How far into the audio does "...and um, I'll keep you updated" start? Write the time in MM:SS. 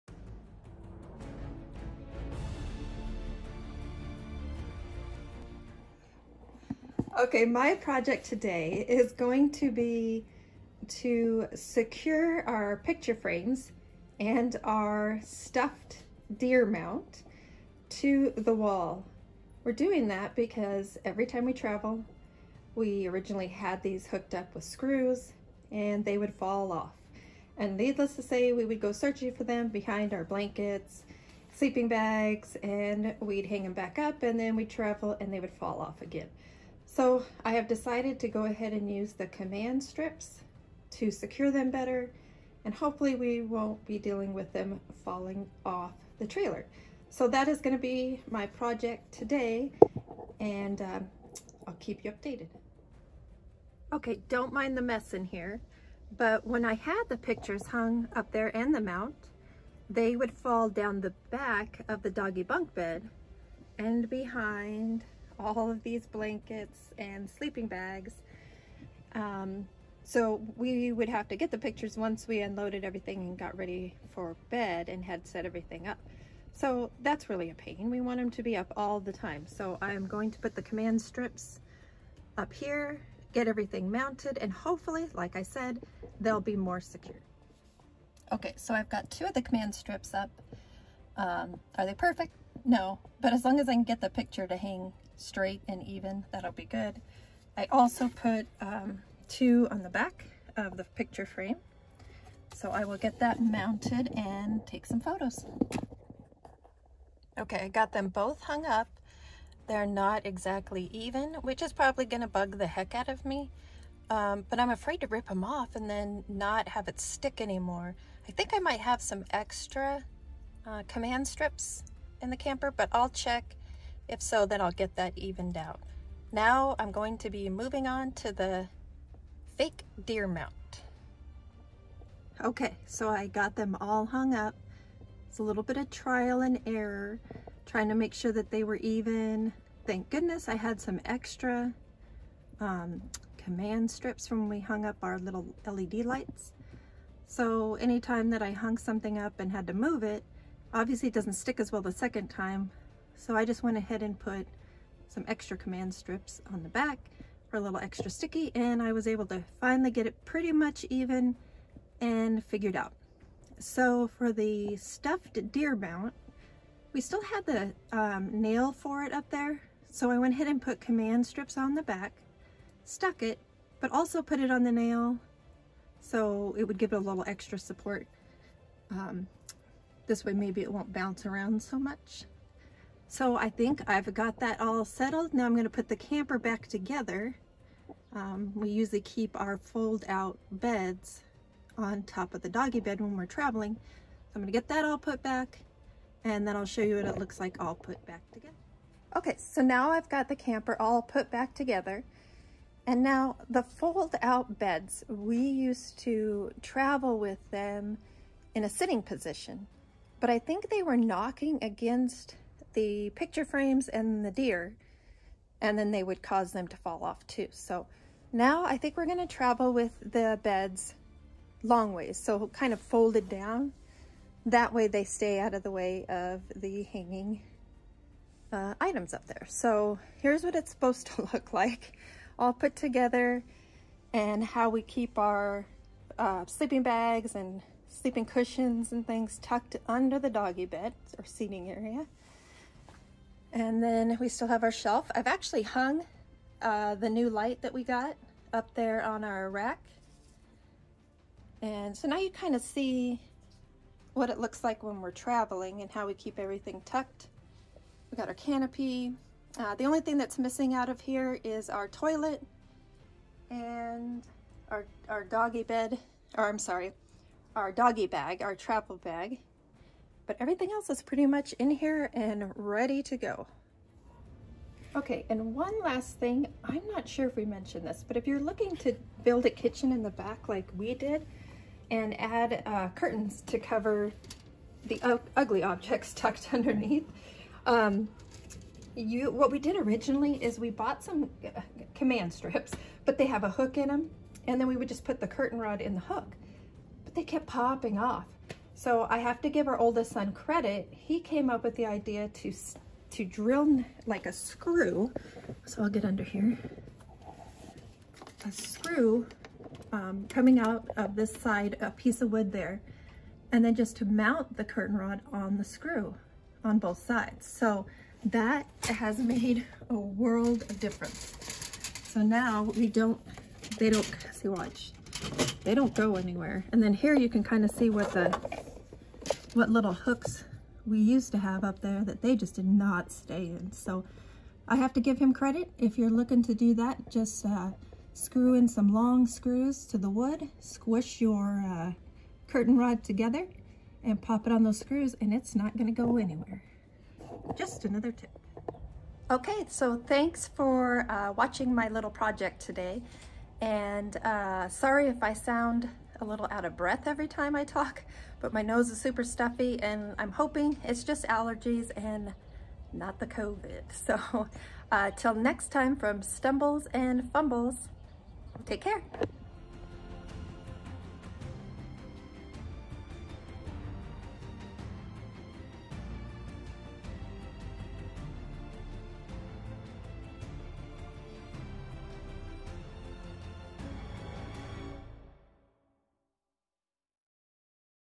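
00:50.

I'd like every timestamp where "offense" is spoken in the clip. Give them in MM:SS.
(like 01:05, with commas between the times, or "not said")
not said.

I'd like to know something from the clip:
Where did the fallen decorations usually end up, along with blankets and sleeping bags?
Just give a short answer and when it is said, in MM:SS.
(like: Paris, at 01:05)
Doggy bunk bed, at 01:02.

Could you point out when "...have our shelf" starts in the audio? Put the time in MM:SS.
04:04.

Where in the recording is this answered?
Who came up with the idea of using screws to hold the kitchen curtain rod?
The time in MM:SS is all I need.
04:59.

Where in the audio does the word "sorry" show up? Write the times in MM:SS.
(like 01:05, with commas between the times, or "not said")
04:26, 05:54.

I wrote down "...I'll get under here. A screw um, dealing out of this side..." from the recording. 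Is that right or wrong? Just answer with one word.
wrong.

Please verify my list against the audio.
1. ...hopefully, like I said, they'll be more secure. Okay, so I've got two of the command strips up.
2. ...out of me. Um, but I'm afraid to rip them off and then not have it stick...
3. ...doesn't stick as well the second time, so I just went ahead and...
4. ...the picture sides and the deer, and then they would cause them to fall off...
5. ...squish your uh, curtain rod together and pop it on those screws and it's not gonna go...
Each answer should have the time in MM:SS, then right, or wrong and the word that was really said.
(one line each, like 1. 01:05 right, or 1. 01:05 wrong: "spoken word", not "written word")
1. 01:24 right
2. 01:52 right
3. 02:31 right
4. 03:32 wrong: "frames", not "sides"
5. 05:40 right.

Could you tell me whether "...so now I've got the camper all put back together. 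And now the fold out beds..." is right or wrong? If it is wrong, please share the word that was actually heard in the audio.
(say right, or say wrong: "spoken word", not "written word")
right.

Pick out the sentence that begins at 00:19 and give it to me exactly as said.
We're doing that because every time we travel, we originally had these hooked up with screws and they would fall off.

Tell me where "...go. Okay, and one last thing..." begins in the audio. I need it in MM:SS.
04:33.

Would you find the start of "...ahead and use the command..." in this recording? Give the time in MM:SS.
00:38.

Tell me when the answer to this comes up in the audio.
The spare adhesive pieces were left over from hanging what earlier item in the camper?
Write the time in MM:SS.
02:25.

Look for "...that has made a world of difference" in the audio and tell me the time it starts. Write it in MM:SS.
05:18.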